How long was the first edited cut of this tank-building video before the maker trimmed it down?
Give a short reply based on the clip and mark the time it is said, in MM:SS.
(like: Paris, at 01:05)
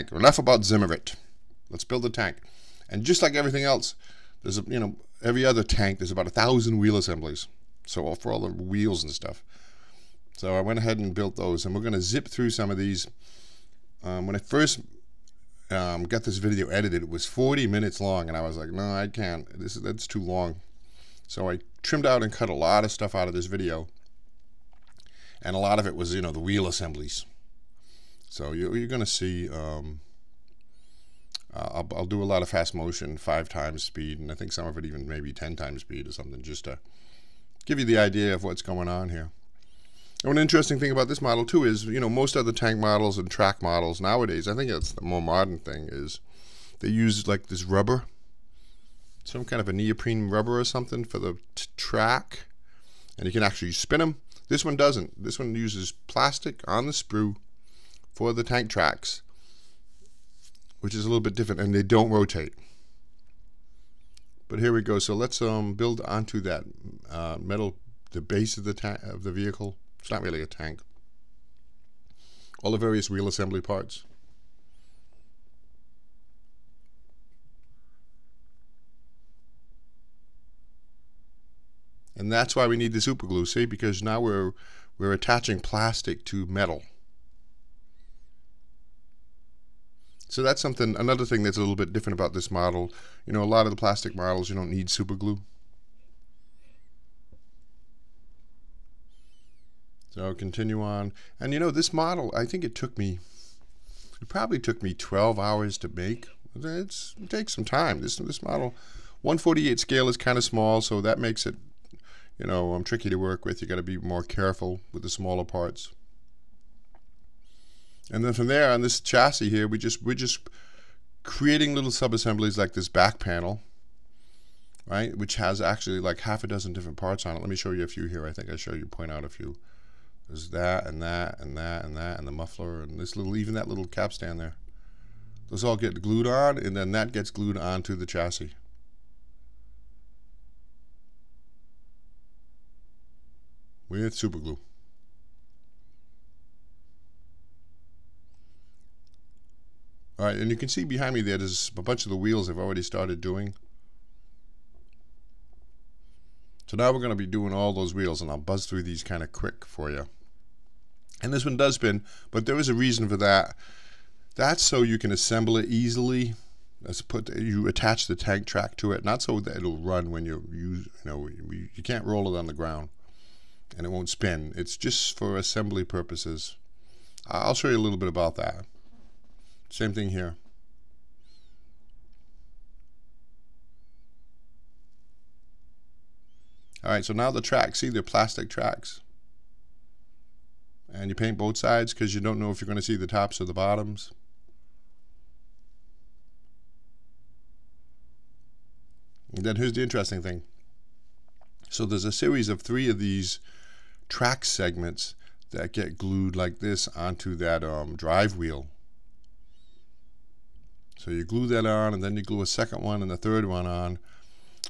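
40 minutes, at 00:17.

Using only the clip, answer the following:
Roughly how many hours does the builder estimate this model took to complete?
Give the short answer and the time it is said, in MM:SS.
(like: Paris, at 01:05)
12, at 01:44.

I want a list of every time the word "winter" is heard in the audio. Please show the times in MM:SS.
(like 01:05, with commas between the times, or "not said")
not said.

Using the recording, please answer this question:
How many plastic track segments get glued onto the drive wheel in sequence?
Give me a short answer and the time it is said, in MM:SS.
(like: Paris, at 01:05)
3, at 03:22.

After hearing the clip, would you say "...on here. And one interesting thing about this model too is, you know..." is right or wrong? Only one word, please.
right.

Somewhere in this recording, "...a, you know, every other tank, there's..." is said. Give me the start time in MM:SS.
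00:04.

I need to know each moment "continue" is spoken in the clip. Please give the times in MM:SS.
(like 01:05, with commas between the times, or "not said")
01:40.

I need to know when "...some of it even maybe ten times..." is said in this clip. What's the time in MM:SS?
00:34.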